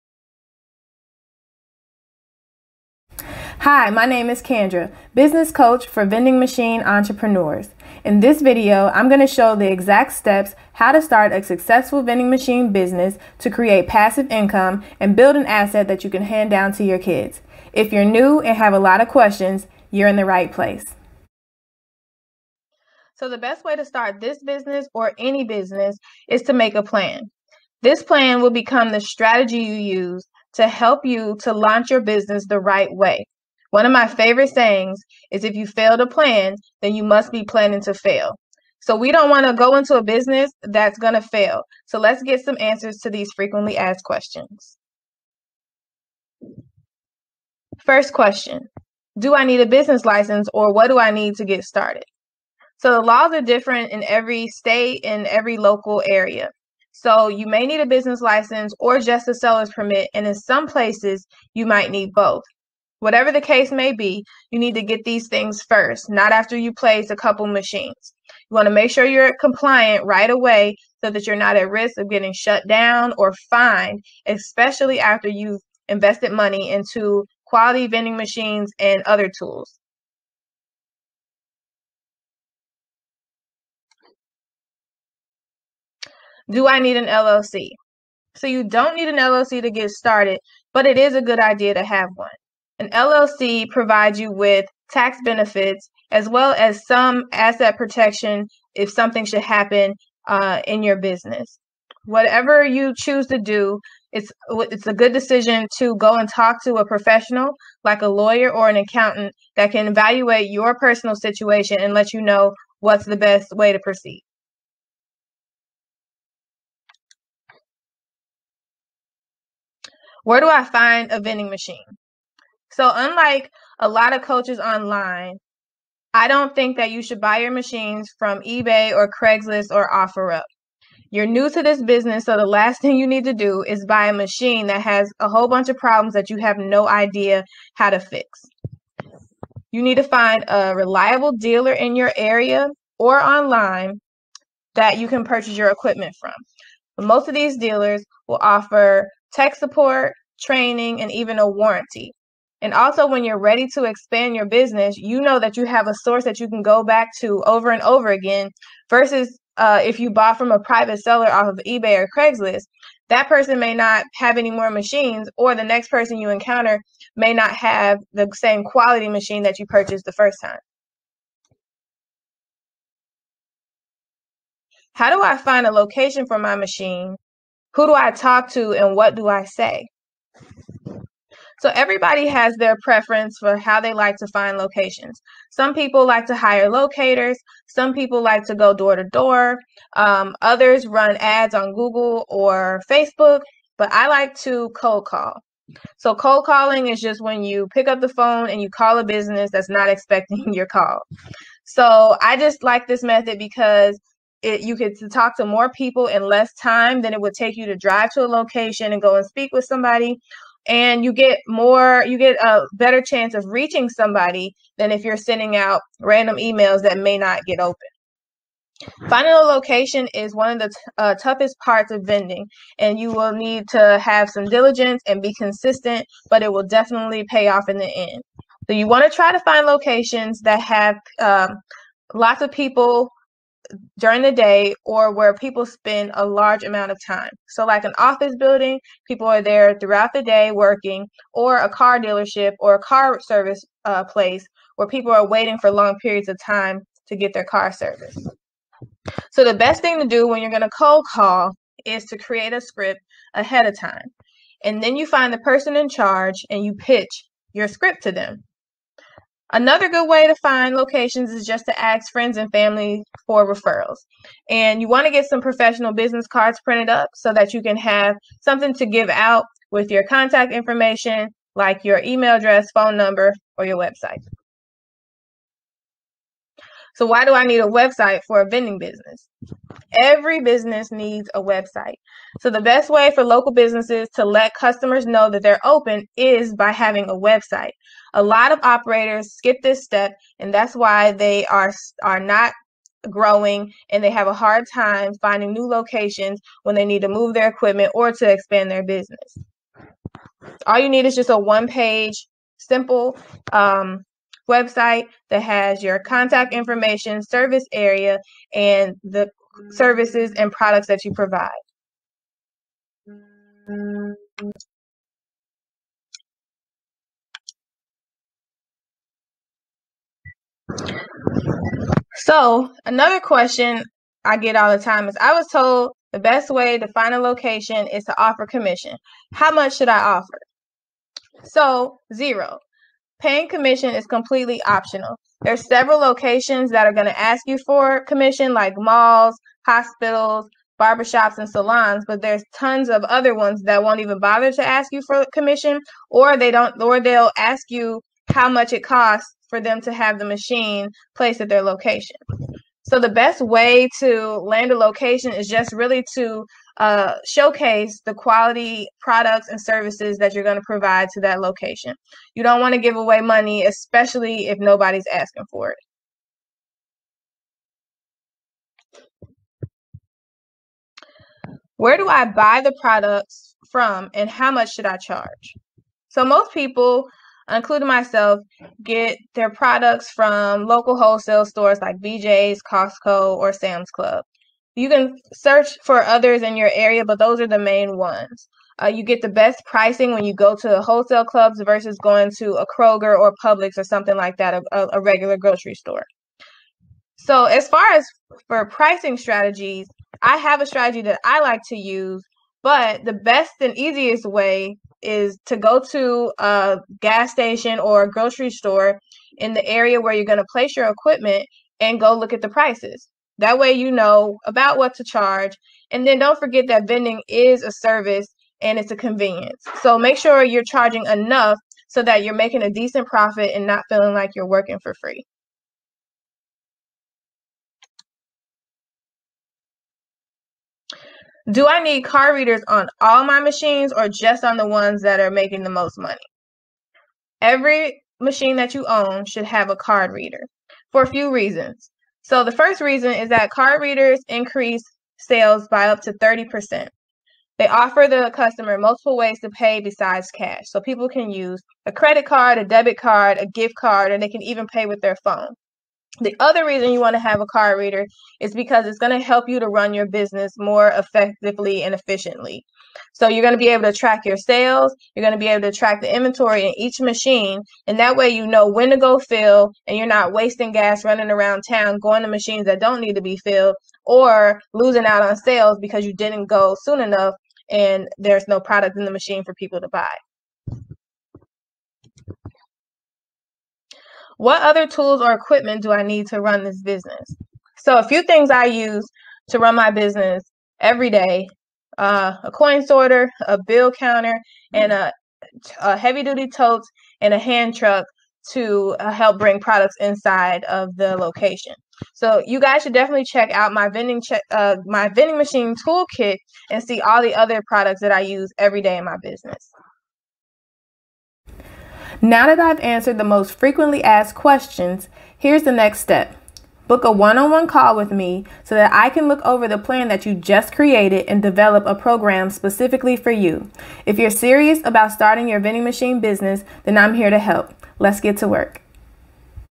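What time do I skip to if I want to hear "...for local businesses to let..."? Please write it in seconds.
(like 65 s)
283 s.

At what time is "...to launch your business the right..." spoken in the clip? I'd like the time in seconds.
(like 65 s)
31 s.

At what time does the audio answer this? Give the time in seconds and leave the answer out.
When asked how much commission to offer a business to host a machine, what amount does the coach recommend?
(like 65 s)
332 s.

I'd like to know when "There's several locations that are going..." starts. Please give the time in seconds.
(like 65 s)
335 s.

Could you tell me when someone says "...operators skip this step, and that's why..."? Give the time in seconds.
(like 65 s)
288 s.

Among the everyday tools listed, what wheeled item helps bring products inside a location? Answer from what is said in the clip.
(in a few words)
Hand truck.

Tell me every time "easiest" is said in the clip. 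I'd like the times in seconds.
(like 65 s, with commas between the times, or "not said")
403 s.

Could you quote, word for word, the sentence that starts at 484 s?
What other tools or equipment do I need to run this business?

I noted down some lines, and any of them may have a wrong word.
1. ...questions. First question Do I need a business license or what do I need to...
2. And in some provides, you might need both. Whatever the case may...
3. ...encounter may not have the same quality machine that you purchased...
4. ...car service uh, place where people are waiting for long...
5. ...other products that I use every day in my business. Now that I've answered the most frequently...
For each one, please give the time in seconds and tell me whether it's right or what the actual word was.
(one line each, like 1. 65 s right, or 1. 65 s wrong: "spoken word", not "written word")
1. 44 s right
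2. 60 s wrong: "places", not "provides"
3. 166 s right
4. 242 s right
5. 507 s right.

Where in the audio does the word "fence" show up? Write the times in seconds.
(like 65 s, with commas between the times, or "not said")
not said.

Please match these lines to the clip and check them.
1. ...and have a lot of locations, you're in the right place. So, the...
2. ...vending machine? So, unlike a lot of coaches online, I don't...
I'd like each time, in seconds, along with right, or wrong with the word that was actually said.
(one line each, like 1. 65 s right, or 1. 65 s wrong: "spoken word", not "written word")
1. 18 s wrong: "questions", not "locations"
2. 121 s right.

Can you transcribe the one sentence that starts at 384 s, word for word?
You can search for others in your area, but those are the main ones.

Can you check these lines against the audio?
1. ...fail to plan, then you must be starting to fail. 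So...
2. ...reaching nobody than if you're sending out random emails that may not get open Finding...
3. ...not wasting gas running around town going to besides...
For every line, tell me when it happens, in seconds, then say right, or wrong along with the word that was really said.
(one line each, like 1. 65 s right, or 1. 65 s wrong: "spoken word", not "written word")
1. 35 s wrong: "planning", not "starting"
2. 213 s wrong: "somebody", not "nobody"
3. 470 s wrong: "machines", not "besides".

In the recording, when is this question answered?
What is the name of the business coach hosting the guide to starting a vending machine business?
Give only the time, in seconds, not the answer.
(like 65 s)
4 s.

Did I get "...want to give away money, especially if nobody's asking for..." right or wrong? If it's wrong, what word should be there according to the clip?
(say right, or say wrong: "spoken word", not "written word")
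right.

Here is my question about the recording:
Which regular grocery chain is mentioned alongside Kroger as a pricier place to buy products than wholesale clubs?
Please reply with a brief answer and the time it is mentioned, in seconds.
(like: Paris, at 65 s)
Publix, at 393 s.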